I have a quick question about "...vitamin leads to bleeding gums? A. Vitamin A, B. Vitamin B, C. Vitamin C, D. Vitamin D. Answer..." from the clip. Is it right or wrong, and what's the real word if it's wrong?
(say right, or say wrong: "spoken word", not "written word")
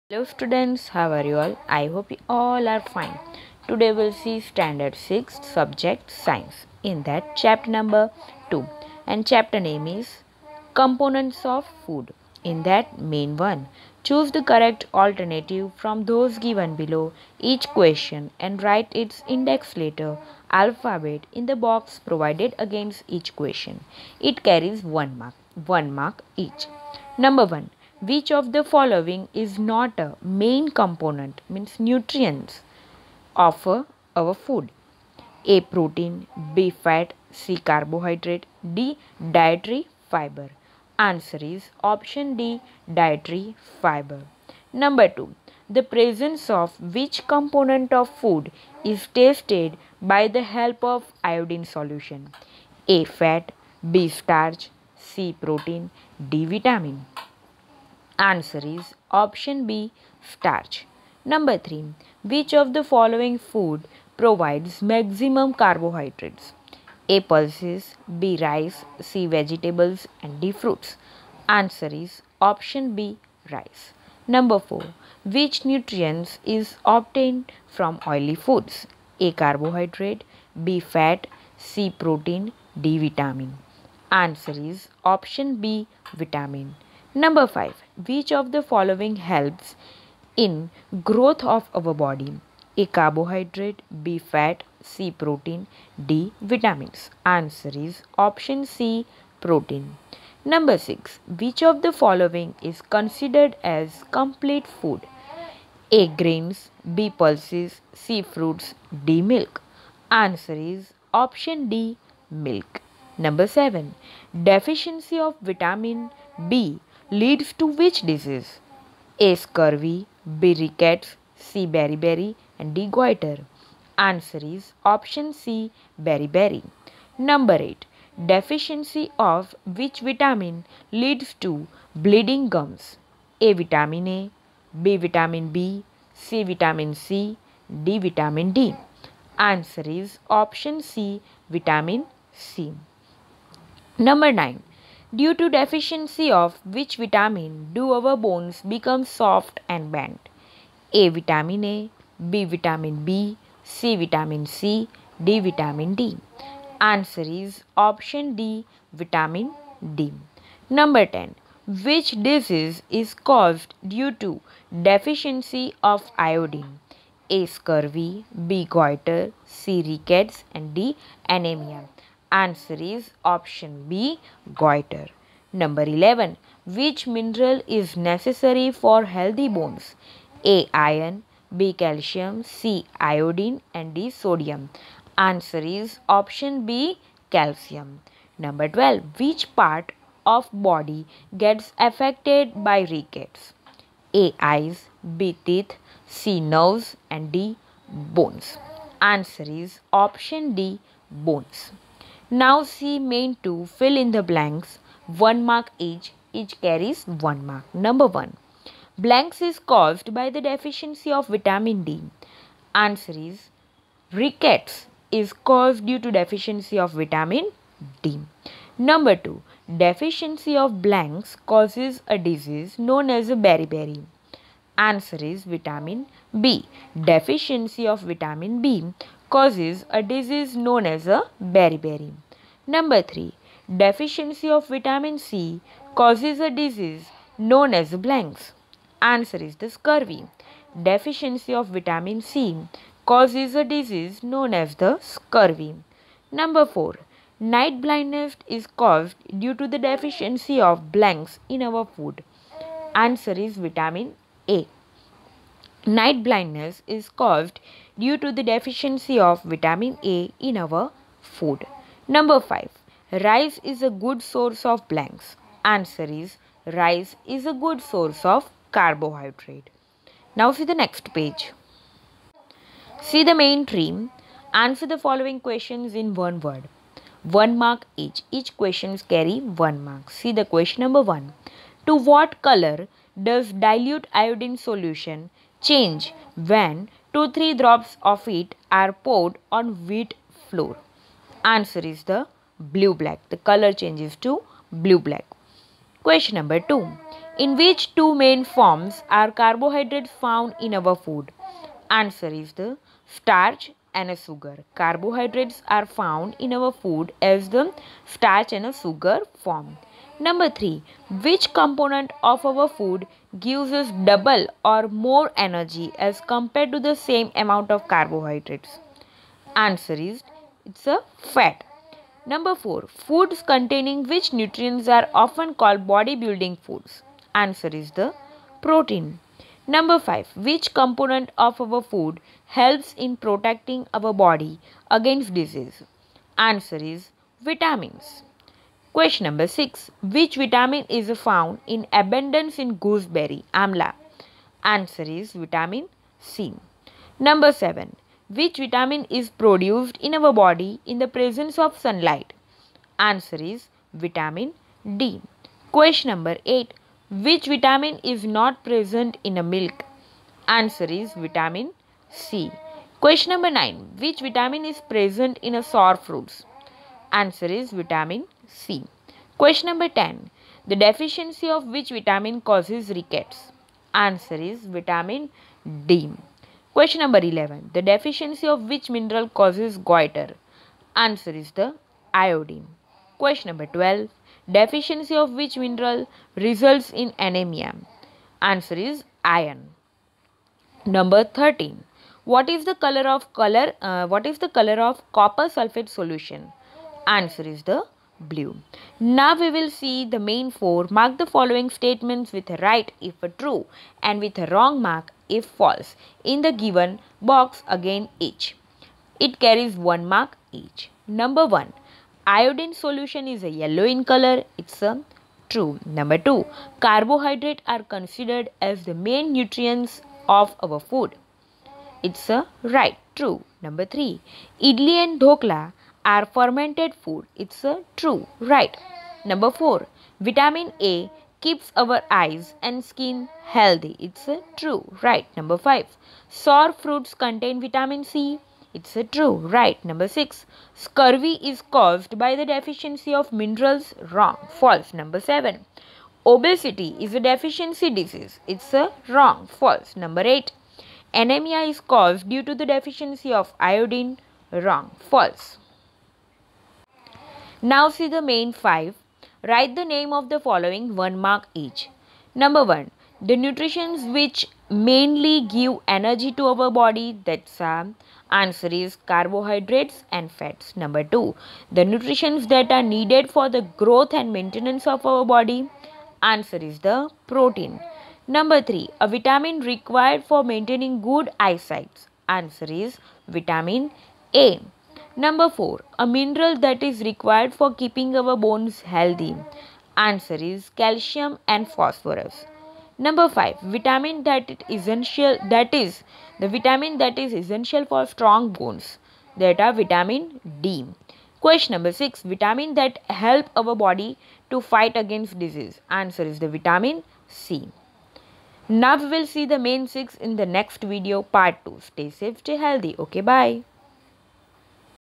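right.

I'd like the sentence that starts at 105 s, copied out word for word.
A grains, B pulses, C fruits, D milk.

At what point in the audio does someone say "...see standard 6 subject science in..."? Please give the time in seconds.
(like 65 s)
4 s.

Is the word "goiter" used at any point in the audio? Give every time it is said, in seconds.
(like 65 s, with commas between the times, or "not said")
122 s, 168 s, 174 s, 379 s.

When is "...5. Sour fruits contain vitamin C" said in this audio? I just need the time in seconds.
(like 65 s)
435 s.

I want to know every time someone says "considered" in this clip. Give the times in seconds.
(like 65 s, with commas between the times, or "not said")
102 s, 417 s.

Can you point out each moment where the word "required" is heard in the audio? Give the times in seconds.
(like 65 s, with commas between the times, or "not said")
479 s, 487 s.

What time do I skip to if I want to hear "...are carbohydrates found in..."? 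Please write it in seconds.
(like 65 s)
299 s.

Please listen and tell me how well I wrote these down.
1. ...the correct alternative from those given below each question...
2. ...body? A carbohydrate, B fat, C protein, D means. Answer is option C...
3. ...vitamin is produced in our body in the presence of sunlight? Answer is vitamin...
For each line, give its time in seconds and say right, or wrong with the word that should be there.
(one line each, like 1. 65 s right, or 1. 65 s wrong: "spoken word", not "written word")
1. 14 s right
2. 91 s wrong: "vitamins", not "means"
3. 348 s right.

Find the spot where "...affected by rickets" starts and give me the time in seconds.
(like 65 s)
191 s.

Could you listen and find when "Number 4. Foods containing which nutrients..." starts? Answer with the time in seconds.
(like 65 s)
322 s.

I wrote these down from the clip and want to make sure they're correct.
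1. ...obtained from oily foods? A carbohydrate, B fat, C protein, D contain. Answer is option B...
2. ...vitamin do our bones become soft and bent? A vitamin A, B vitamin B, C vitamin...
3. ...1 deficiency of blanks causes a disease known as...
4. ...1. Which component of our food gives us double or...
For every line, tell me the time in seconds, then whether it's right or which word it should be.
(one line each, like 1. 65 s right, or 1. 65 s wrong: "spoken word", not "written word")
1. 76 s wrong: "vitamin", not "contain"
2. 146 s right
3. 219 s wrong: "2", not "1"
4. 310 s wrong: "3", not "1".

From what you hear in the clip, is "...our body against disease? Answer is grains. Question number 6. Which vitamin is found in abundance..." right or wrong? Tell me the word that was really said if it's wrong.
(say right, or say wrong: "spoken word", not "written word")
wrong: "vitamins", not "grains".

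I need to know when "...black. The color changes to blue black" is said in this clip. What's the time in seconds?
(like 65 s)
293 s.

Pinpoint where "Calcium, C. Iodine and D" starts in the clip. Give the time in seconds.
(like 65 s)
181 s.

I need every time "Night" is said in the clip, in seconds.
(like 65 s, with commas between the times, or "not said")
247 s, 255 s.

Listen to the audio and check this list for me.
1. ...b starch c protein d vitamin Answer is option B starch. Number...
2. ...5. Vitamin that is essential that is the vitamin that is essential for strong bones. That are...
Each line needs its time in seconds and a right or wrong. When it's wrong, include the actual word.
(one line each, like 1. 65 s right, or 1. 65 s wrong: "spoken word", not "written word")
1. 53 s right
2. 493 s right.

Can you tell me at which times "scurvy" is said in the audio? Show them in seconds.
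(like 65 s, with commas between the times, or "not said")
119 s, 167 s, 239 s, 244 s, 440 s.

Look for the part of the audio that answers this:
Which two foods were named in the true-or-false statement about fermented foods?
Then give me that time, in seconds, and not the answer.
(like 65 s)
424 s.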